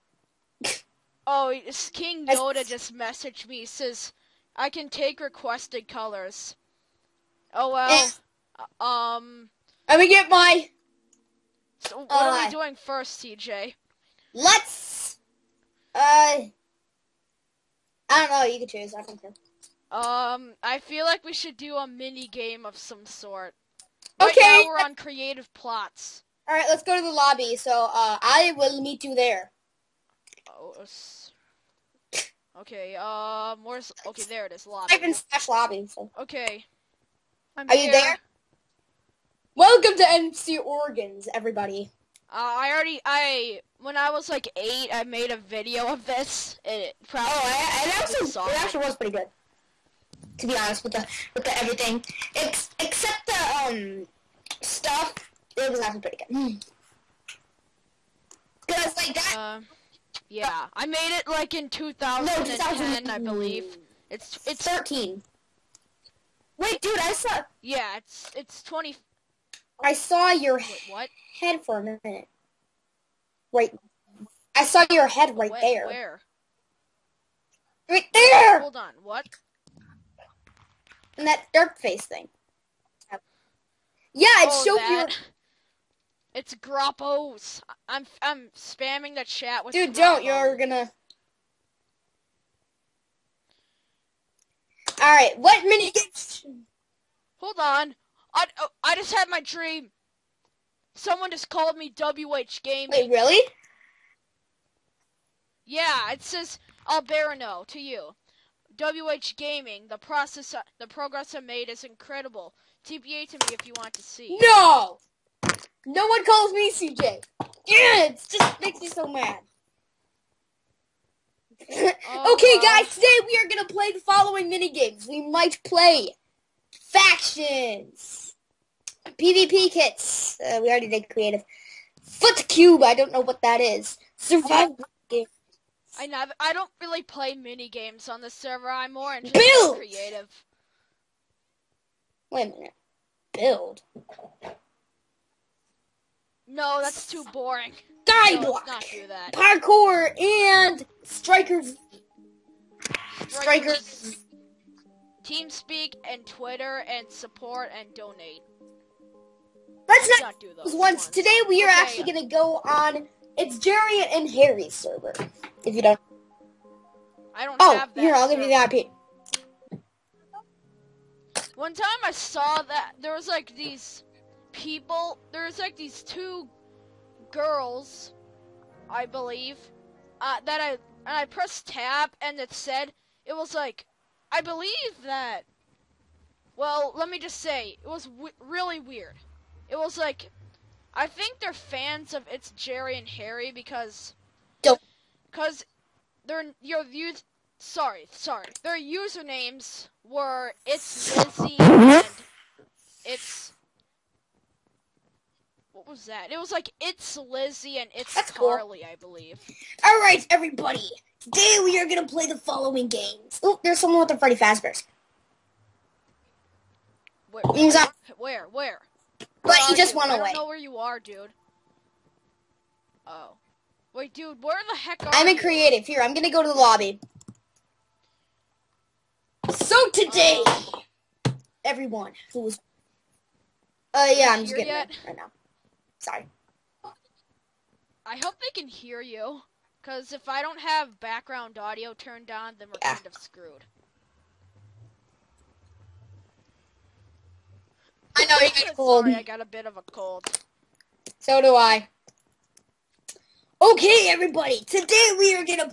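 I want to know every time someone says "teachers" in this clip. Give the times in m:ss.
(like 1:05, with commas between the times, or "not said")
not said.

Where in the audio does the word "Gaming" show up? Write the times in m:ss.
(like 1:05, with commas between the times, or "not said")
1:42, 1:49.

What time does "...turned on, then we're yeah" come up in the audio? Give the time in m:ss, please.
4:01.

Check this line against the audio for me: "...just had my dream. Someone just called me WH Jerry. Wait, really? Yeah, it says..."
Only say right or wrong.
wrong.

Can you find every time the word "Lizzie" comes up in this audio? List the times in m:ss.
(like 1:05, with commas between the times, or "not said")
3:21, 3:27.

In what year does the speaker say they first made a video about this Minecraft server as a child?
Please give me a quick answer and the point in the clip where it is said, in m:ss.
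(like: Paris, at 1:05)
2010, at 1:02.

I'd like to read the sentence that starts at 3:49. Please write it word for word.
So today, uh, everyone who was...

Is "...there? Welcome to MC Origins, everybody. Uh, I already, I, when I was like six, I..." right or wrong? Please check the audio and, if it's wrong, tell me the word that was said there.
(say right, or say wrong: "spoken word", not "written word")
wrong: "eight", not "six".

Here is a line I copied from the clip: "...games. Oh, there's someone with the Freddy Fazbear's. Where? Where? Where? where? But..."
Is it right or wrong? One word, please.
right.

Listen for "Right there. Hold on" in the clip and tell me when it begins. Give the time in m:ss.
1:17.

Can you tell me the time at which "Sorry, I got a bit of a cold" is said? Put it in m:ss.
4:09.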